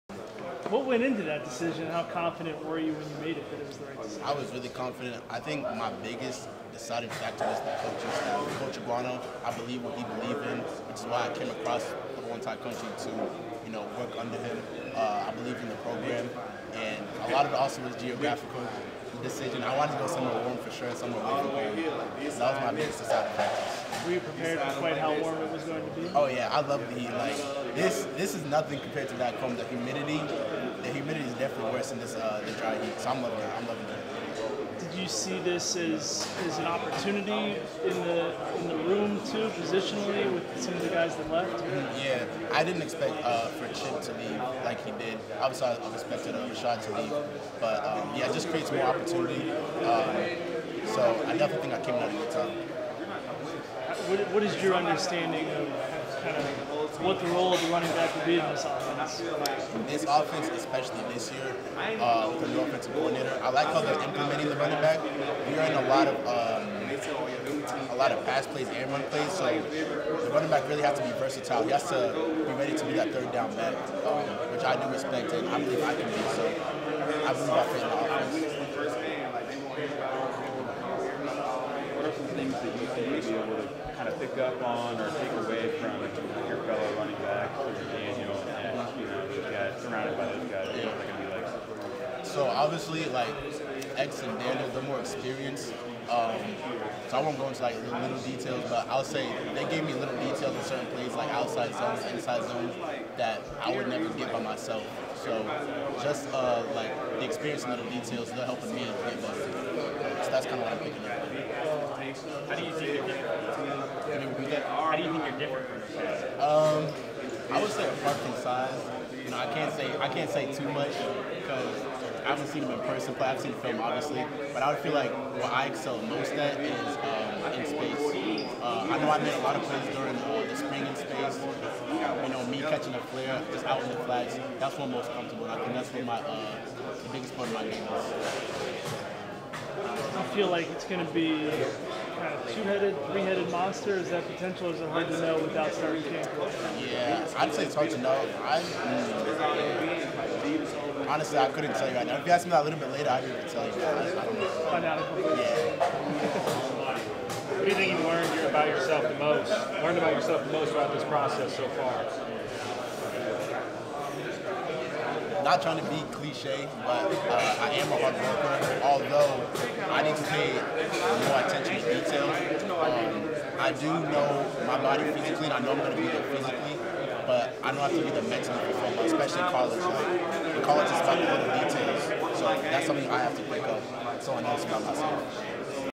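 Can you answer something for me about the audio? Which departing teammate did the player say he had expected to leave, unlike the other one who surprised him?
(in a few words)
Rachaad.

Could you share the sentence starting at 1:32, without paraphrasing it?
So obviously, like X and Daniyel, they're more experienced.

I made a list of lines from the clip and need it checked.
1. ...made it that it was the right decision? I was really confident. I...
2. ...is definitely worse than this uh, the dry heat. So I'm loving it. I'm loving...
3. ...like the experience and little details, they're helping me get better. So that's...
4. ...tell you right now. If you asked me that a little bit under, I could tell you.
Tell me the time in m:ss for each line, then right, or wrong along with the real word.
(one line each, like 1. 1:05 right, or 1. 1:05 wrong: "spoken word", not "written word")
1. 0:03 right
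2. 0:31 right
3. 1:46 right
4. 2:31 wrong: "later", not "under".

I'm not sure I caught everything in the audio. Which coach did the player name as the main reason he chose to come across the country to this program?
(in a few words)
Coach Aguano.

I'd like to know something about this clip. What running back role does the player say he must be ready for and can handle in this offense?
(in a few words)
third down back.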